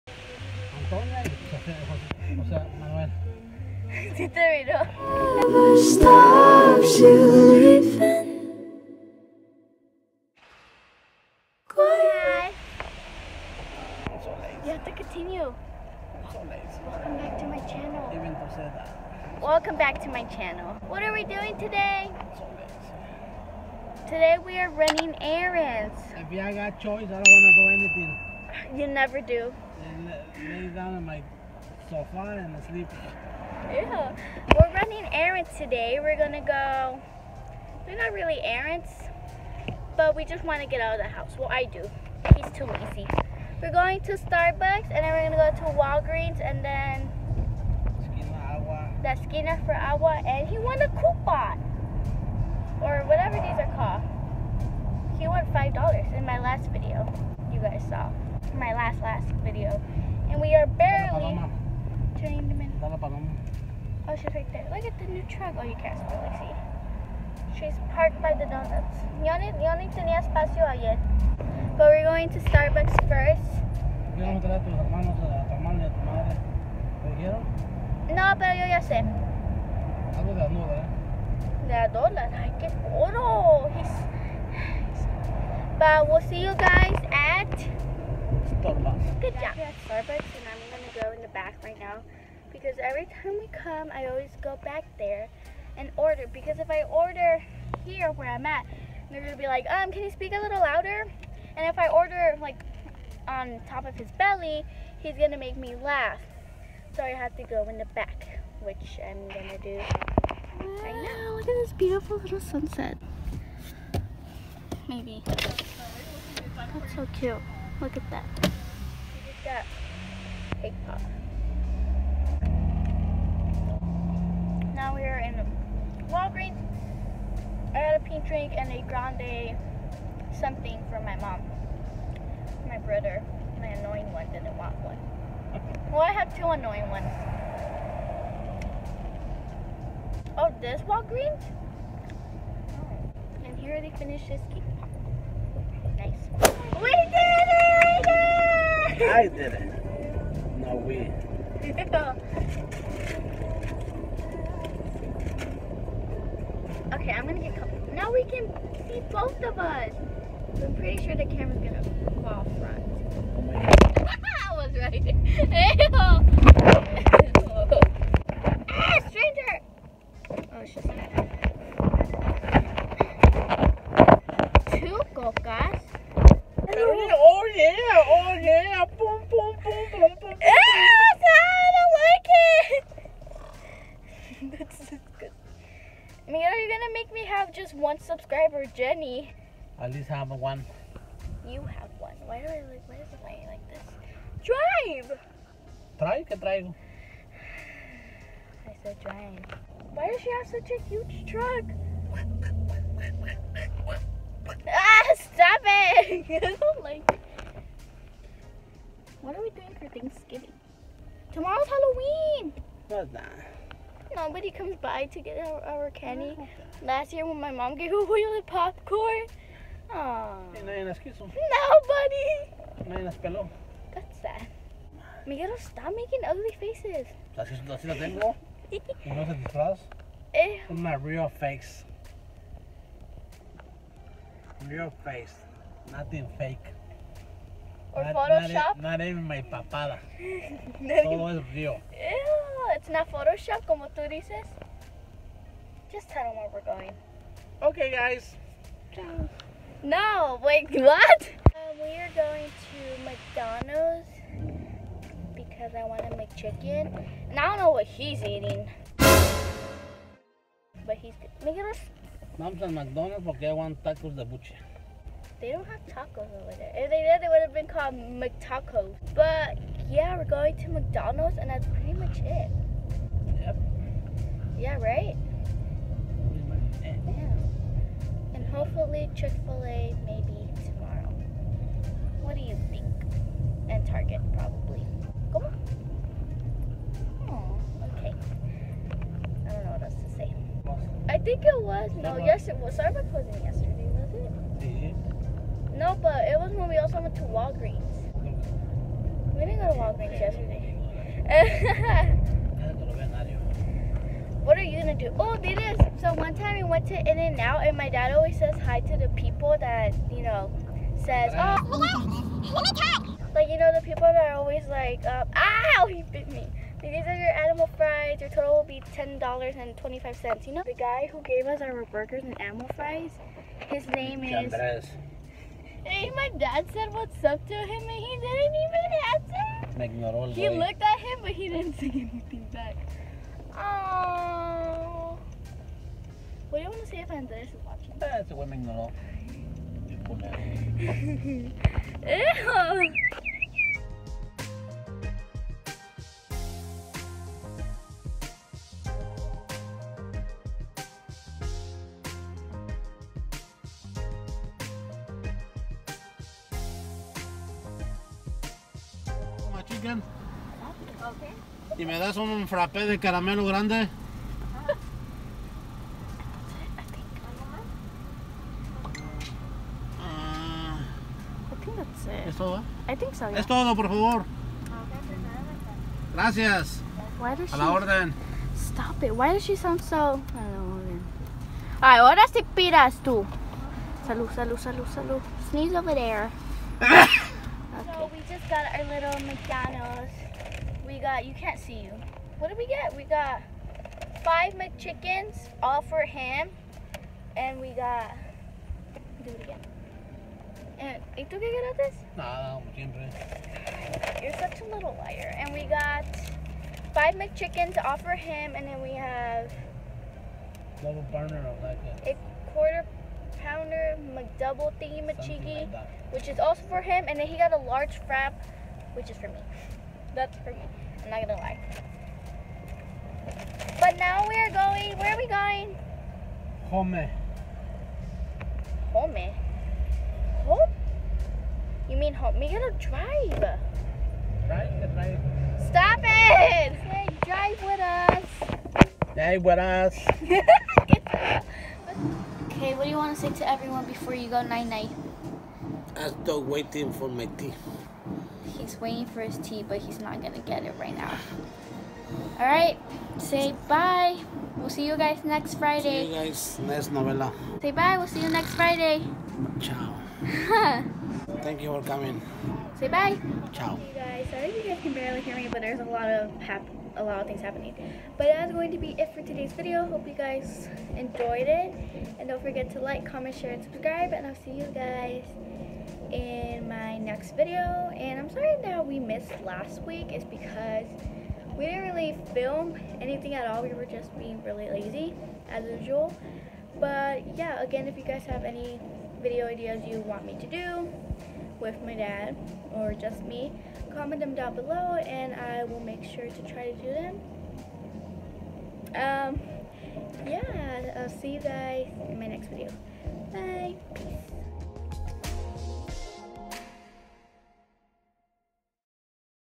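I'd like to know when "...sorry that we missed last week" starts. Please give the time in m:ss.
7:58.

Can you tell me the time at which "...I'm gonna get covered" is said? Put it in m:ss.
2:37.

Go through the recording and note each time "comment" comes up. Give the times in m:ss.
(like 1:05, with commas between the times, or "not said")
7:53, 8:13.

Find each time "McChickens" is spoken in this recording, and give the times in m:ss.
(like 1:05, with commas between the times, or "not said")
6:34, 6:47.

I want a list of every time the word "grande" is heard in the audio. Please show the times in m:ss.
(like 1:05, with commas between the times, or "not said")
2:08, 6:03.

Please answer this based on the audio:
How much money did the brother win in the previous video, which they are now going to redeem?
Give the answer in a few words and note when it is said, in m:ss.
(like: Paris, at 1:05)
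$5, at 0:55.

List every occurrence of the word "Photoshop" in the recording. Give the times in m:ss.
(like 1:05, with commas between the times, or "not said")
3:58, 4:03.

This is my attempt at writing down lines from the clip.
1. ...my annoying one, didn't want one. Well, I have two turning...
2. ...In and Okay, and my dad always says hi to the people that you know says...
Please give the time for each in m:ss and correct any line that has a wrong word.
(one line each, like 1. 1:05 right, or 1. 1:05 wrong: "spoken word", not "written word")
1. 2:13 wrong: "annoying", not "turning"
2. 5:06 wrong: "Out", not "Okay".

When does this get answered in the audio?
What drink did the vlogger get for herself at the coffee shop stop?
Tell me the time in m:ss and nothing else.
2:08.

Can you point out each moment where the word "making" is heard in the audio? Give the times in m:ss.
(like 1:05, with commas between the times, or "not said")
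3:45, 4:21.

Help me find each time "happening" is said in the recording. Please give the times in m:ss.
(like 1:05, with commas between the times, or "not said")
7:47.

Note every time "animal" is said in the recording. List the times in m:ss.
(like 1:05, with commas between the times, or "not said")
5:17, 5:22.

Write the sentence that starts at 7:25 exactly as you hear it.
I'm still waiting for my tea.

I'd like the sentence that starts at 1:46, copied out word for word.
So I have to go in the back, which I'm going to do right now.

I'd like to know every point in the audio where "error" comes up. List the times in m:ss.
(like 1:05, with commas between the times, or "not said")
not said.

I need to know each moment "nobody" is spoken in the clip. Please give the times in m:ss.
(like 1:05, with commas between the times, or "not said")
3:34, 3:40.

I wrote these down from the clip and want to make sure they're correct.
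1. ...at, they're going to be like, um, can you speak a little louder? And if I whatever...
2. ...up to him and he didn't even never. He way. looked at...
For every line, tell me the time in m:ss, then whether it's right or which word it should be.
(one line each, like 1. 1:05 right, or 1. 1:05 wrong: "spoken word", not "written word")
1. 1:38 wrong: "order", not "whatever"
2. 5:27 wrong: "answer", not "never".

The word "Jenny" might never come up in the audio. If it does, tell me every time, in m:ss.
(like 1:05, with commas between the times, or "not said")
3:08.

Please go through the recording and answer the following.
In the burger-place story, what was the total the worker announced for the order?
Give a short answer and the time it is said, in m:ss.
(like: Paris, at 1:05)
$10.25, at 5:18.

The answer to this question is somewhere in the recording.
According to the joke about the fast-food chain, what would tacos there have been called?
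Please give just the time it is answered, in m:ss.
4:27.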